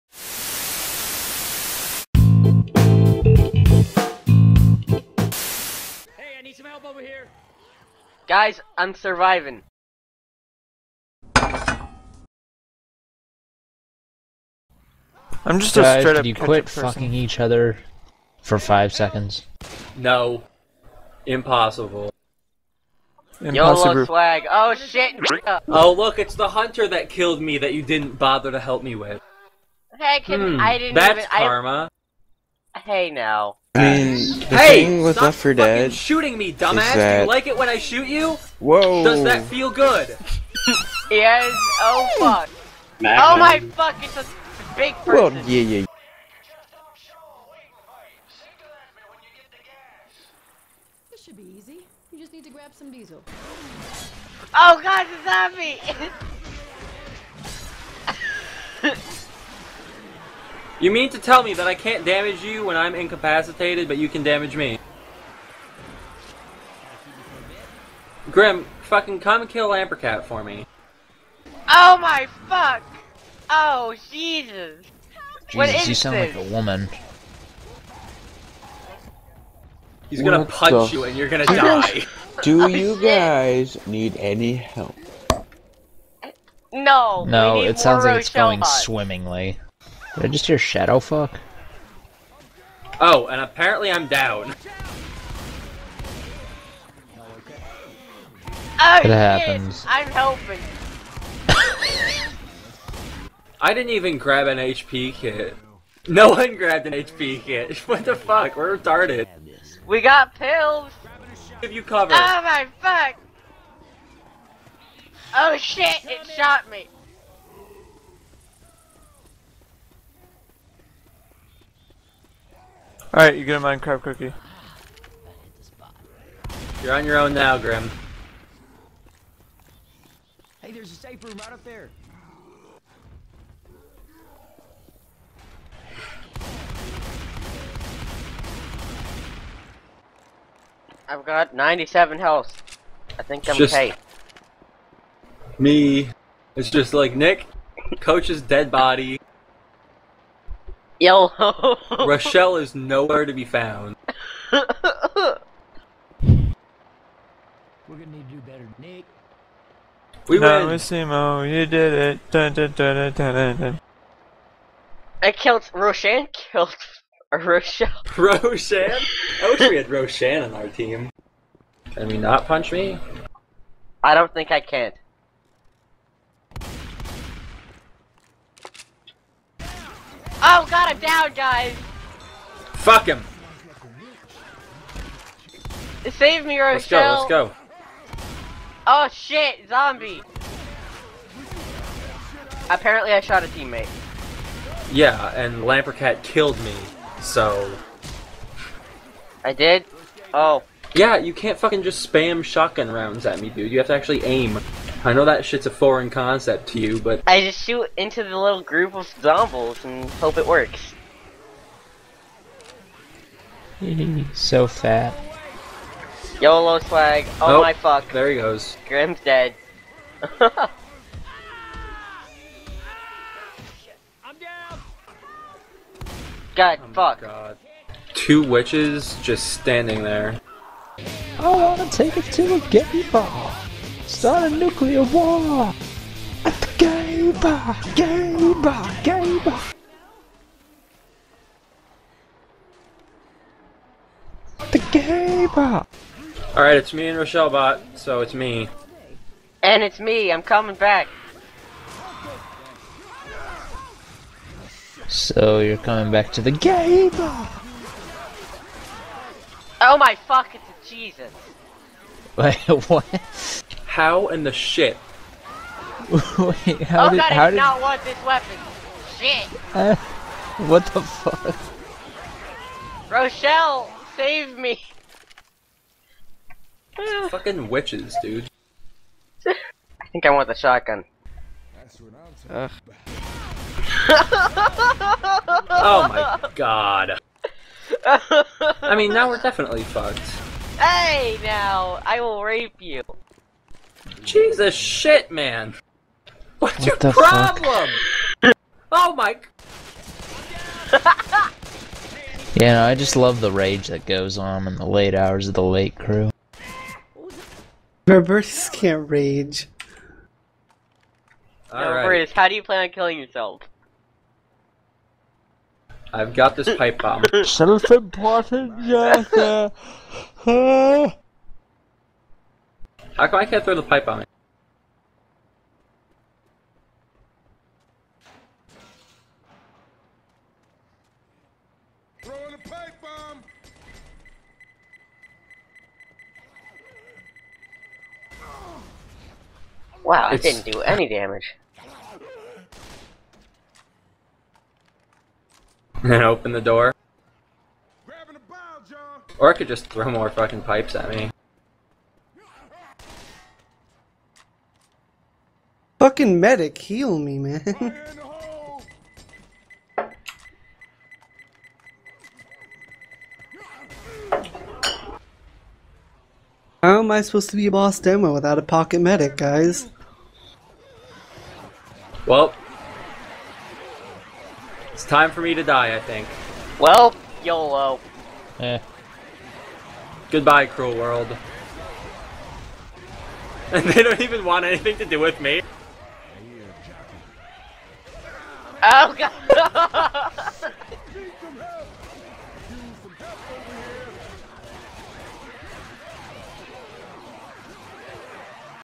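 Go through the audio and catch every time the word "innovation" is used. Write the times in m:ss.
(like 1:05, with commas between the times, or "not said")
not said.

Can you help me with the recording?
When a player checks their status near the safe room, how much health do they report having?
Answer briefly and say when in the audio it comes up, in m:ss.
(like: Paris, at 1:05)
97, at 2:21.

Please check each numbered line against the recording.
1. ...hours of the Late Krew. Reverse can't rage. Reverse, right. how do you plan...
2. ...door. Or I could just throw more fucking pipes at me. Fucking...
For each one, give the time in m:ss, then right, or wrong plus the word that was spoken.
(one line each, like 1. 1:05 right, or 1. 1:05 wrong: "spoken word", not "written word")
1. 5:05 right
2. 5:46 right.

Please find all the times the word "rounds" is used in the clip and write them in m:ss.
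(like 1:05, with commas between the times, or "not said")
3:22.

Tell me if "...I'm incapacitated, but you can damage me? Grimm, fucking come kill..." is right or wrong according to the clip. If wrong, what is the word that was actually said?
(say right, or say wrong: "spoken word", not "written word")
right.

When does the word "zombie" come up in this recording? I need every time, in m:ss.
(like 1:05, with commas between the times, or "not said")
0:55, 3:09, 3:29.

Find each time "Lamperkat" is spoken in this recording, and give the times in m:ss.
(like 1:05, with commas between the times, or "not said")
1:09, 3:15.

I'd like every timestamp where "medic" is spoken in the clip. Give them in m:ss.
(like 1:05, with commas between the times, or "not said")
5:56, 6:08.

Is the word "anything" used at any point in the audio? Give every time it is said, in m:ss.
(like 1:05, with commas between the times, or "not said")
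6:24.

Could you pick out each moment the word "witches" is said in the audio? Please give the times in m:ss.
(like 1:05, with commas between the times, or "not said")
3:48, 4:37.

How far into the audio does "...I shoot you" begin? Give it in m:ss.
0:37.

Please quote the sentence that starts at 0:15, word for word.
I'm just Guys, a straight up.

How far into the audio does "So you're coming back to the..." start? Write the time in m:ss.
4:15.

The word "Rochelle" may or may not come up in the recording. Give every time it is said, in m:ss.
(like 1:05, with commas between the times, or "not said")
2:32, 2:47, 3:06, 4:07, 4:33.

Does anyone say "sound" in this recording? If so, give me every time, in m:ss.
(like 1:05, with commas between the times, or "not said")
1:15, 1:27.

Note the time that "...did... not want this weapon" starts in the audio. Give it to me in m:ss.
4:27.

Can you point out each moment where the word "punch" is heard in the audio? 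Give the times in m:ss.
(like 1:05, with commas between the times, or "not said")
1:20, 2:52.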